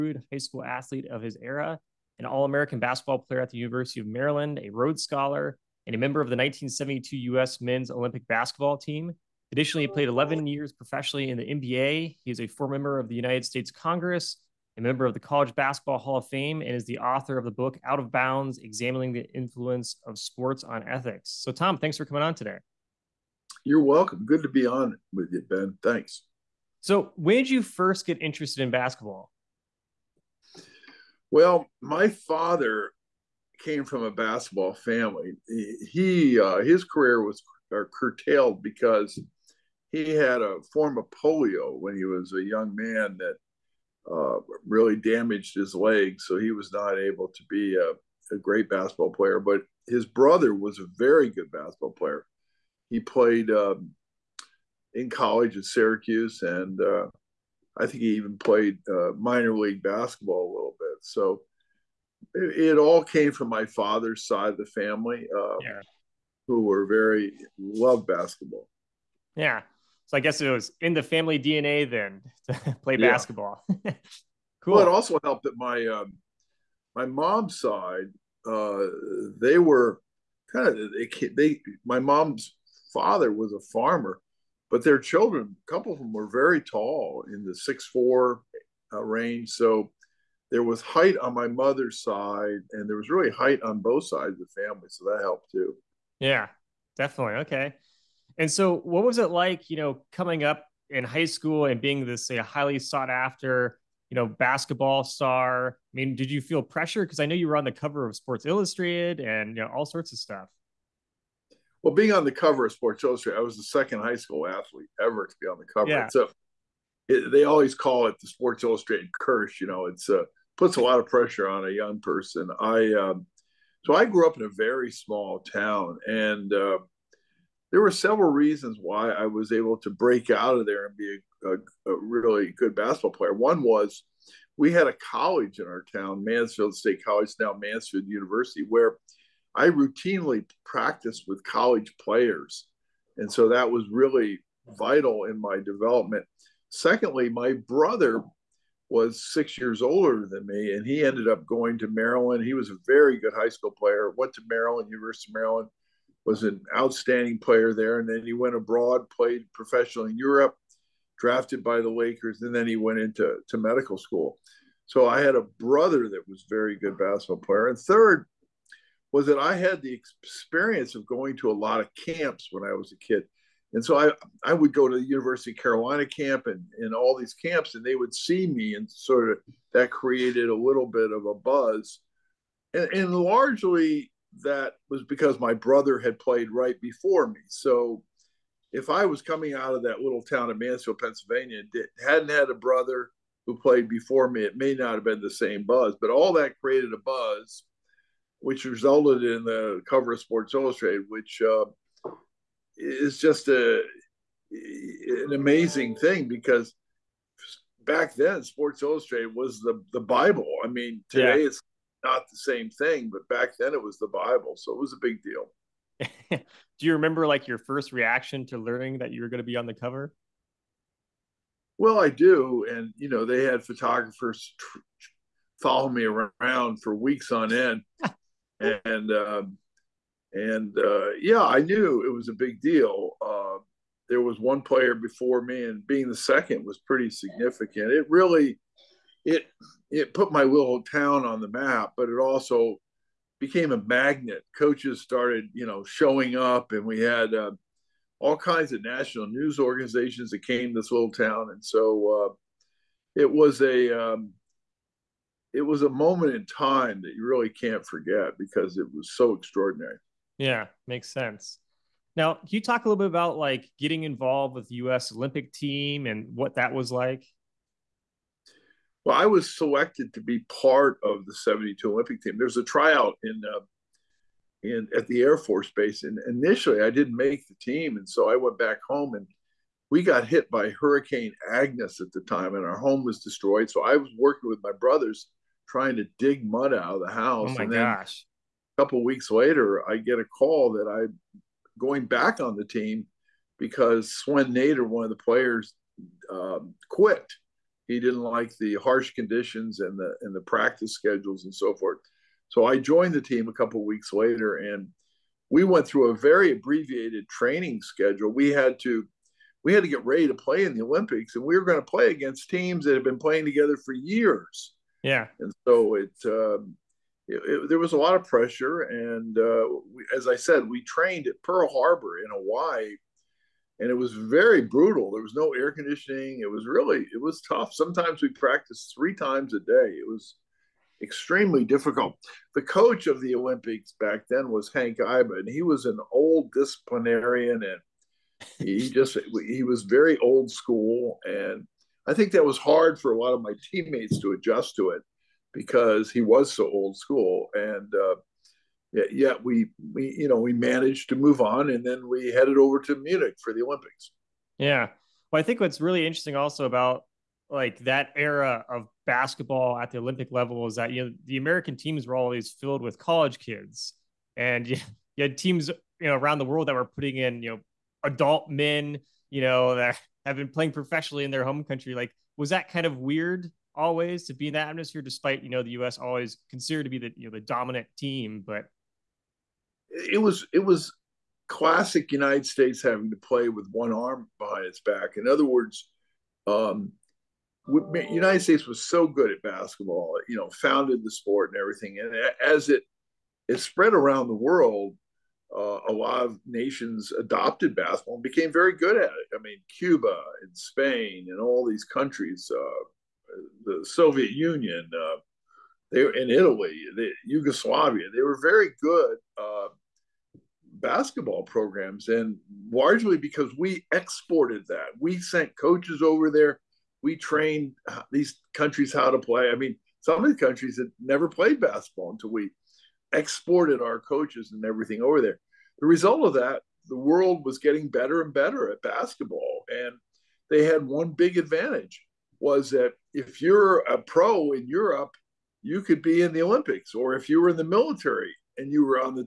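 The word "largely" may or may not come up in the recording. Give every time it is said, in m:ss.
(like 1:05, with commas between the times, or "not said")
3:03, 6:52.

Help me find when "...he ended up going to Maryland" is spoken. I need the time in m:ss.
2:30.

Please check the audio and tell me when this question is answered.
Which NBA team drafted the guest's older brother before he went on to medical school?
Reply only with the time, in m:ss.
2:41.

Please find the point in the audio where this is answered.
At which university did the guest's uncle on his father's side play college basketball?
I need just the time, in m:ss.
0:55.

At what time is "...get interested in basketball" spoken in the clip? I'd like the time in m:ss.
0:28.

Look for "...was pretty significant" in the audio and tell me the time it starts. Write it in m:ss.
3:56.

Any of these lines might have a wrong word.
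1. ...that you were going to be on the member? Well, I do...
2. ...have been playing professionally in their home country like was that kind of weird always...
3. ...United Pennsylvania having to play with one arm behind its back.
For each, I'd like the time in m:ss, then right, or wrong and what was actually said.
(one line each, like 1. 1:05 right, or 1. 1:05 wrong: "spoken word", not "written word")
1. 3:38 wrong: "cover", not "member"
2. 6:10 right
3. 6:22 wrong: "States", not "Pennsylvania".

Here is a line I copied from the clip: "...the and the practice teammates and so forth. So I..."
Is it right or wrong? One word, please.
wrong.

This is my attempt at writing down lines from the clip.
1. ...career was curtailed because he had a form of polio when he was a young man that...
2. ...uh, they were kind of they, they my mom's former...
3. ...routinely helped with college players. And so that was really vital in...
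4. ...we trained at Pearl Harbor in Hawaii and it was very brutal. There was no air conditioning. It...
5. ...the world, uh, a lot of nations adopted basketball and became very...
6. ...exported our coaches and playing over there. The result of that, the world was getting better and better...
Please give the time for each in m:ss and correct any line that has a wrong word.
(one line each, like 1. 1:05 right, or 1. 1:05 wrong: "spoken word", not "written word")
1. 0:36 right
2. 1:18 wrong: "father", not "former"
3. 2:19 wrong: "practiced", not "helped"
4. 5:20 right
5. 6:34 right
6. 7:03 wrong: "everything", not "playing".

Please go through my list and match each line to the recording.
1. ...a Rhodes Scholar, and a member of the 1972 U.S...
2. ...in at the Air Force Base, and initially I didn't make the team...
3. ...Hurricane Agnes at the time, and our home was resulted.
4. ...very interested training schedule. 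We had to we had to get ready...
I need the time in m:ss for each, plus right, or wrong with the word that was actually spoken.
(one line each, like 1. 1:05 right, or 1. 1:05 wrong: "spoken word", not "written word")
1. 0:04 right
2. 4:34 right
3. 4:40 wrong: "destroyed", not "resulted"
4. 5:06 wrong: "abbreviated", not "interested".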